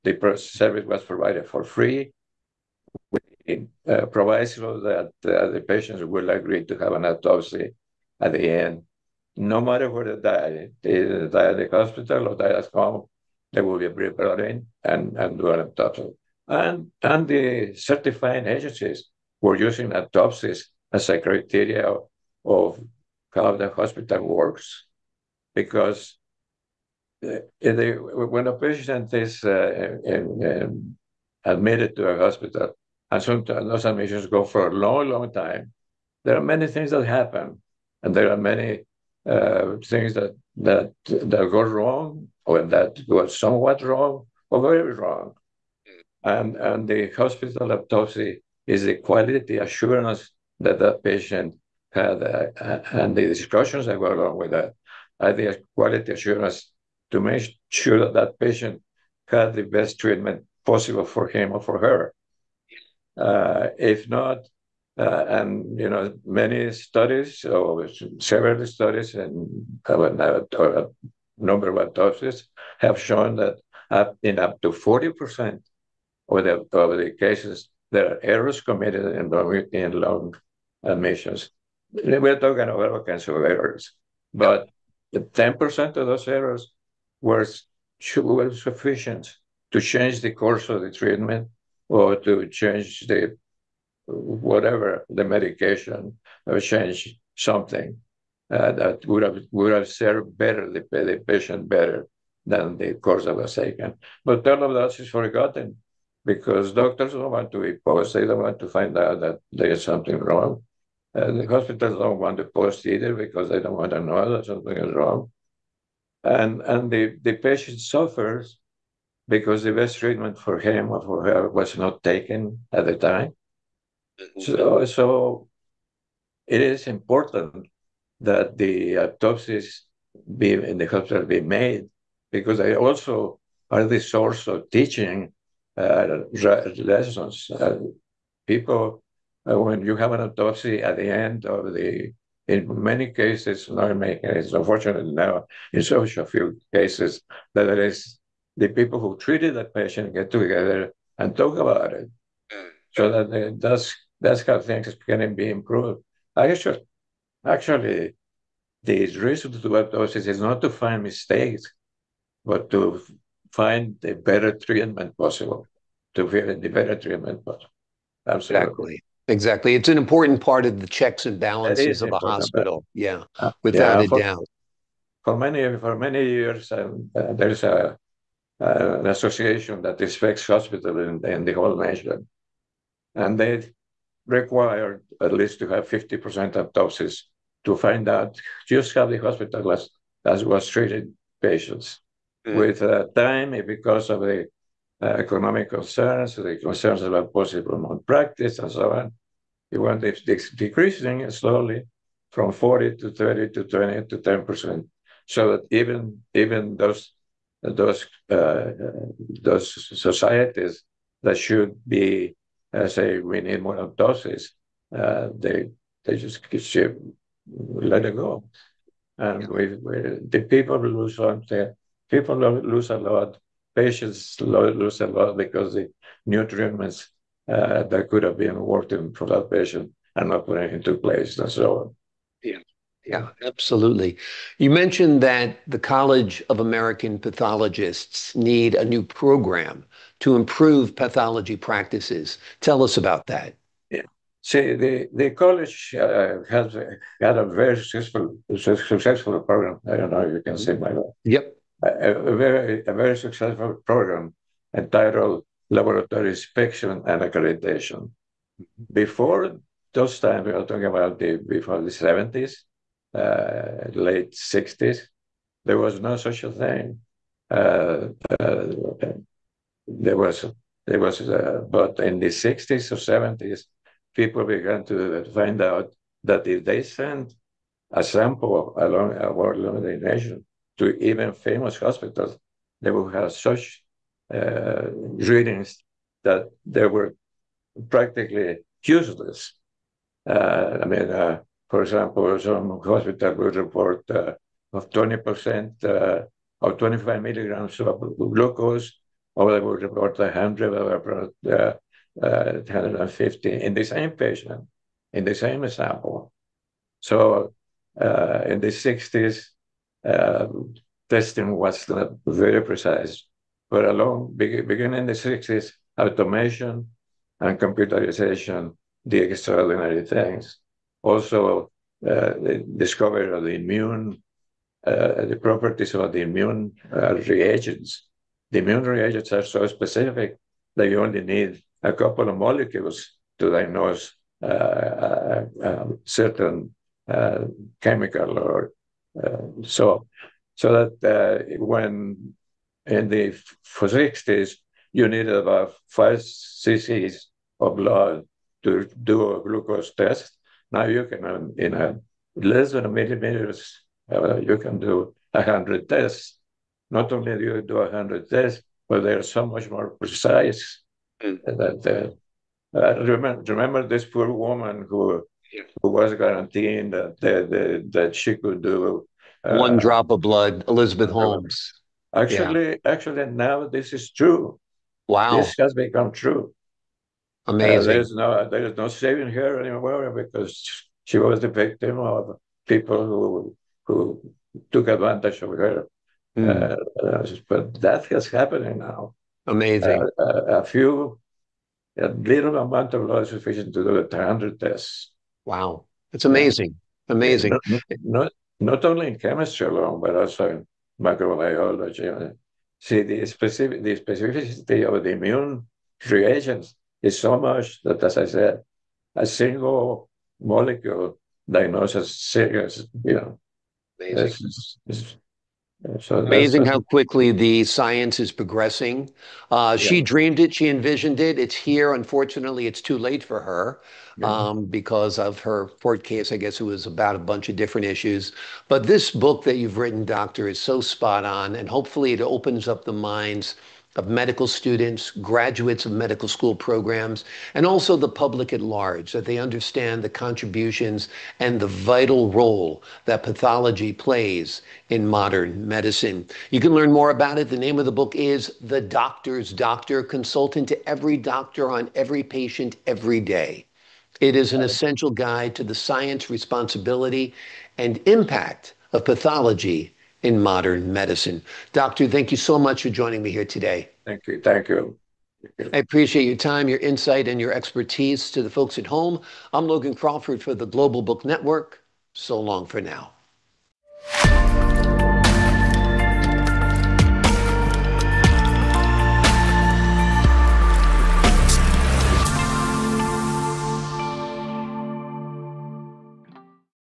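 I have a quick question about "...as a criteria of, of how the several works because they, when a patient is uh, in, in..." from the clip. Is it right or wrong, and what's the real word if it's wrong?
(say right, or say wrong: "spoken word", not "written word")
wrong: "hospital", not "several".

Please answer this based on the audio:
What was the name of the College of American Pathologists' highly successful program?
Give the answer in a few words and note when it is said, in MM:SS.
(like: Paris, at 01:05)
Laboratory inspection and accreditation, at 04:15.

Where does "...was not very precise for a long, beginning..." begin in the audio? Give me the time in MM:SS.
05:11.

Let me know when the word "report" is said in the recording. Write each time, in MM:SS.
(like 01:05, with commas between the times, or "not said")
04:53, 04:59.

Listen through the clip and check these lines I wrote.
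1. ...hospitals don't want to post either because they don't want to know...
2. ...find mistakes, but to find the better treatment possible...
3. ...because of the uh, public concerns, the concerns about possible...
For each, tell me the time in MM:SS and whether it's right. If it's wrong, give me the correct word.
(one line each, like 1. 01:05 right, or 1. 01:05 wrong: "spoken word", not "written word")
1. 01:51 right
2. 02:40 right
3. 03:13 wrong: "economic", not "public".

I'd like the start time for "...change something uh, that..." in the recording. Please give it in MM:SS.
01:36.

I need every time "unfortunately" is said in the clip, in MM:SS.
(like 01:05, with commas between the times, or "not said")
02:24, 07:01.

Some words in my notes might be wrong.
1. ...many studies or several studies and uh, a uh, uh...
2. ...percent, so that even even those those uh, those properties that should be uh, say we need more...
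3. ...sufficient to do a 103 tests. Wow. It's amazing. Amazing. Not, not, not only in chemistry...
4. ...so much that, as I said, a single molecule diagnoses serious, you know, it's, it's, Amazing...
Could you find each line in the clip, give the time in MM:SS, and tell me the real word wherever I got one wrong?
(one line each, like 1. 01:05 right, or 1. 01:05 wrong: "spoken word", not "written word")
1. 01:06 right
2. 03:24 wrong: "societies", not "properties"
3. 06:33 wrong: "100", not "103"
4. 06:47 right.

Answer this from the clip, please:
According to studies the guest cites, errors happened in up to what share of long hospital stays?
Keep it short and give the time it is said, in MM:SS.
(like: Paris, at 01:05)
40%, at 01:14.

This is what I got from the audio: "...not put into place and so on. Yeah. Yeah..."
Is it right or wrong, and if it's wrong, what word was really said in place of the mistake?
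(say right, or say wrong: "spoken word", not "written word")
right.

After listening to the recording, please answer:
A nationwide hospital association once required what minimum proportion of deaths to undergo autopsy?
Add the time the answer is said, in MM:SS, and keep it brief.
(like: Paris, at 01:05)
50%, at 03:05.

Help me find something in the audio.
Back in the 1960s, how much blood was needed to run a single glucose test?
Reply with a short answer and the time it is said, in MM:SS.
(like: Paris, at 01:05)
5 cc, at 05:45.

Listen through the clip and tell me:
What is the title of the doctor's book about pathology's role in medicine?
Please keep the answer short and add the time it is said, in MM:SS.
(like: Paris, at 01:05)
The Doctor's Doctor, at 07:28.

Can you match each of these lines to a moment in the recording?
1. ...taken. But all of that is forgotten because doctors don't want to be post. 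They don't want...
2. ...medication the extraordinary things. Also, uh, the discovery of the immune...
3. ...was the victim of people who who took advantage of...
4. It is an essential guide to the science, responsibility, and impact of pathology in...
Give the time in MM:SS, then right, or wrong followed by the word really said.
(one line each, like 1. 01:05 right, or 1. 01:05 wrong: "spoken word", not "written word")
1. 01:43 right
2. 05:17 wrong: "computerization", not "medication"
3. 06:21 right
4. 07:34 right.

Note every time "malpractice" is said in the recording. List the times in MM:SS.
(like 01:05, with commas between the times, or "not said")
03:17.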